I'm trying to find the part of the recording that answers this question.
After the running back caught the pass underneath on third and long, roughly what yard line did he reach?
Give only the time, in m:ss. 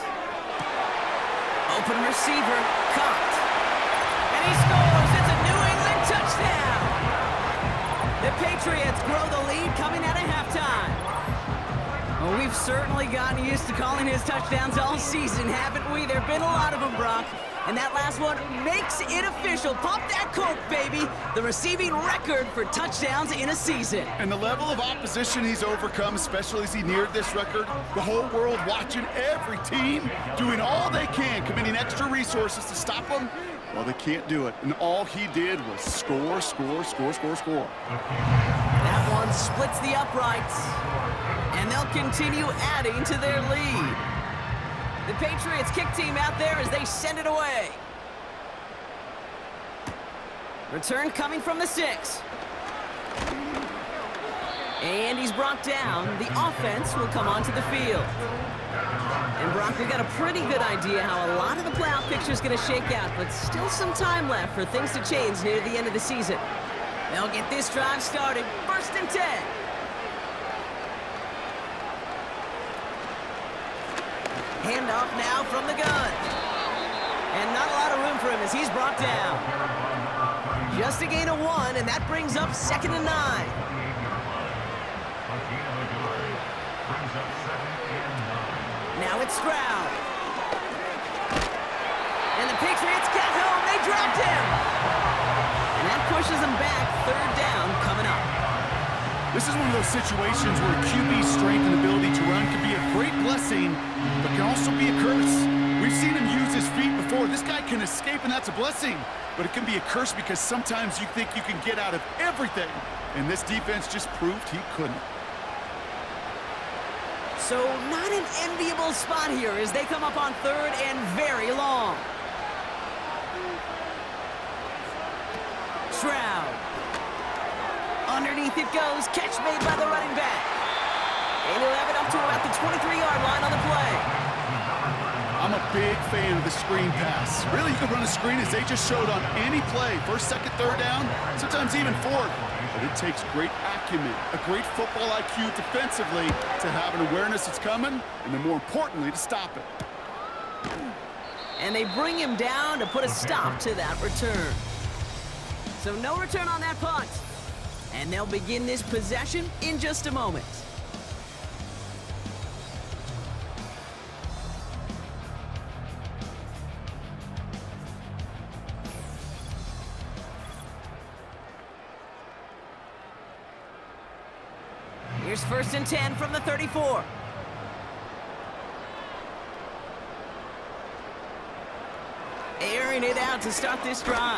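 2:12.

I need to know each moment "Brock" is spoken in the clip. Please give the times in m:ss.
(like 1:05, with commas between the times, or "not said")
0:16, 0:59.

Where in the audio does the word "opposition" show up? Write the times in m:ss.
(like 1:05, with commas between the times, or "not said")
0:24.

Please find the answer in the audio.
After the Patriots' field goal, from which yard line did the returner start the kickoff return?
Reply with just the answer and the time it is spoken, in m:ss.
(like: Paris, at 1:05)
6, at 0:51.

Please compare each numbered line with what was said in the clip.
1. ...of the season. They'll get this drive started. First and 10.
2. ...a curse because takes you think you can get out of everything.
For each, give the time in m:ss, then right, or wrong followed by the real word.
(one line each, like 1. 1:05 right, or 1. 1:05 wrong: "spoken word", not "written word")
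1. 1:05 right
2. 1:49 wrong: "sometimes", not "takes".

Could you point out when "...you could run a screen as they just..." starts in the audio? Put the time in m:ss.
2:17.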